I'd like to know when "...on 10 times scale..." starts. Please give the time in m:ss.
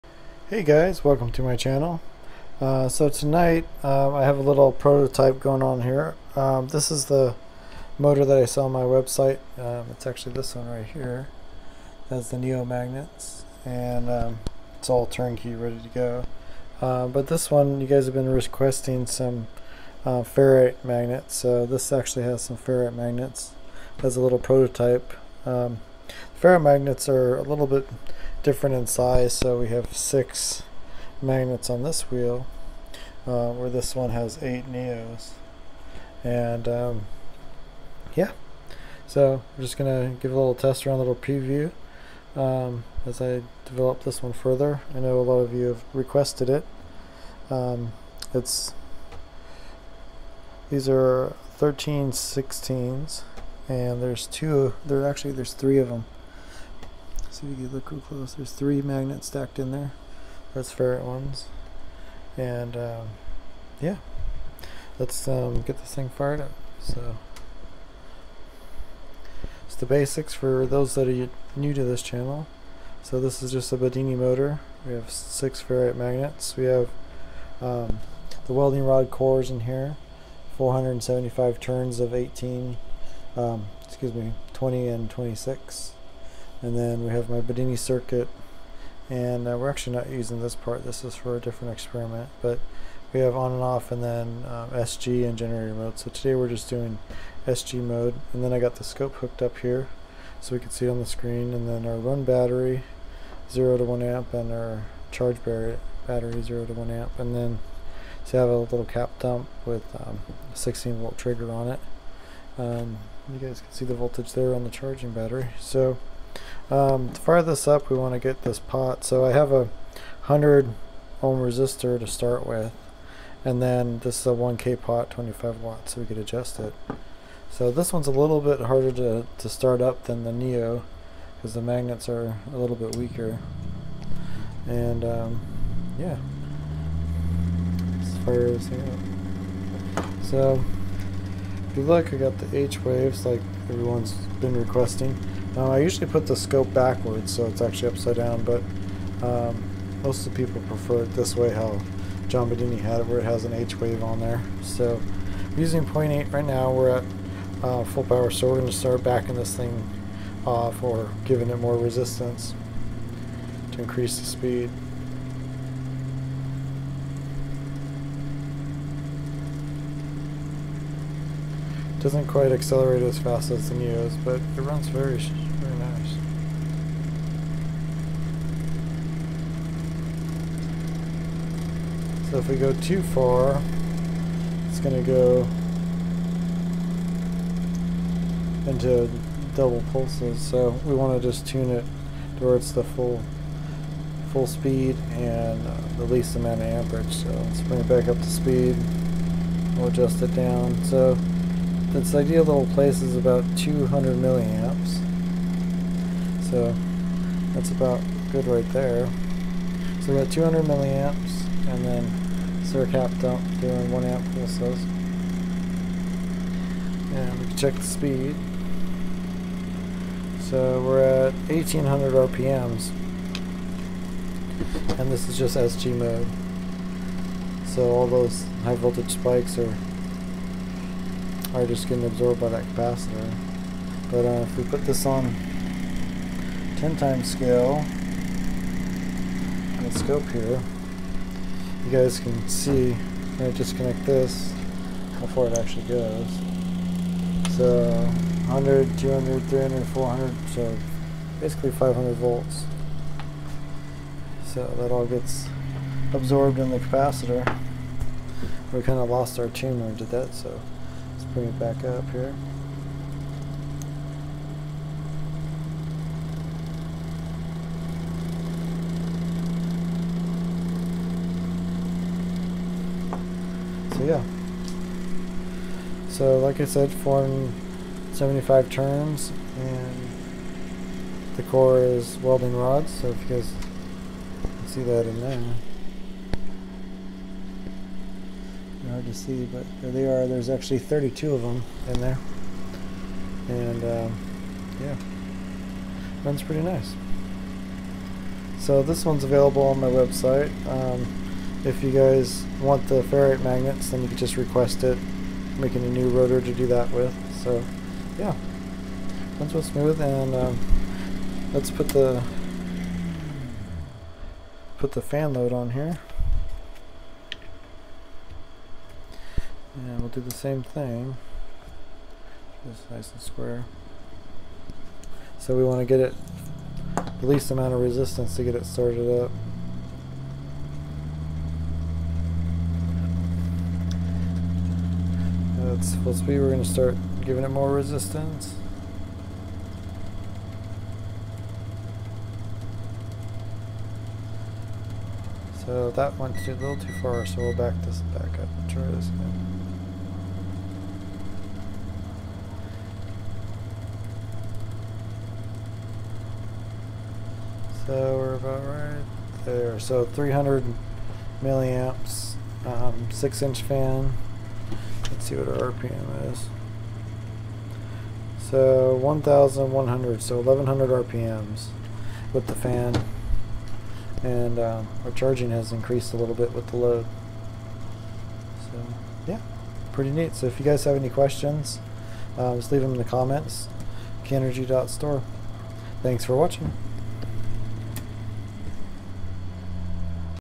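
3:55.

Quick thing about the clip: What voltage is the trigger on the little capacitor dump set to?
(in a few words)
16 volts.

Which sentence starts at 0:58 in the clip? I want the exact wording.
There's three magnets stacked in there.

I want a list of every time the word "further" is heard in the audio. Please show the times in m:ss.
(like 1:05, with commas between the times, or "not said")
0:44.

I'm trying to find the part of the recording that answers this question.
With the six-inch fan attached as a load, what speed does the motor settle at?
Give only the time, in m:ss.
6:10.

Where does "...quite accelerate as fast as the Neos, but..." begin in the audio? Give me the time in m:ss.
2:52.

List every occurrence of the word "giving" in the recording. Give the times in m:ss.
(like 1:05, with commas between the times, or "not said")
2:41, 5:37.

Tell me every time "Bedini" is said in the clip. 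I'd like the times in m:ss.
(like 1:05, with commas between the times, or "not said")
1:13, 1:27, 2:32.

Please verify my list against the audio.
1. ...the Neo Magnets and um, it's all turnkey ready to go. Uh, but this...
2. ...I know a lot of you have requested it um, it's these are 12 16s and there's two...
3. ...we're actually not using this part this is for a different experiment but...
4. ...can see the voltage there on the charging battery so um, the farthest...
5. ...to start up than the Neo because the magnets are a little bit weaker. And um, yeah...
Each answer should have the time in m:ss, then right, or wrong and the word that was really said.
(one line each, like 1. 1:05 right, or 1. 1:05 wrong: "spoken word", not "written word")
1. 0:12 right
2. 0:44 wrong: "13", not "12"
3. 1:29 right
4. 1:53 right
5. 2:09 right.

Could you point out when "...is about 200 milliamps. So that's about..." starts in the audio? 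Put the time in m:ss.
3:23.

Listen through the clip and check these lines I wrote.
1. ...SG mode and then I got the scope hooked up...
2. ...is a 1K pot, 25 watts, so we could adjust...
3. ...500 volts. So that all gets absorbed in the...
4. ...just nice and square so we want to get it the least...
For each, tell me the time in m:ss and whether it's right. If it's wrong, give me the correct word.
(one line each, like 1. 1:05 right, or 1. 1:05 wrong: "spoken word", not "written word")
1. 1:37 right
2. 2:04 right
3. 4:11 right
4. 5:22 right.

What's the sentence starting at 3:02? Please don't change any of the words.
So if we go too far, it's going to go into double pulses.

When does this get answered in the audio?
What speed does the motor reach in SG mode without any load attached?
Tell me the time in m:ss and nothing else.
3:41.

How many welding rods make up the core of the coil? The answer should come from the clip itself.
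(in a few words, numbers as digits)
32.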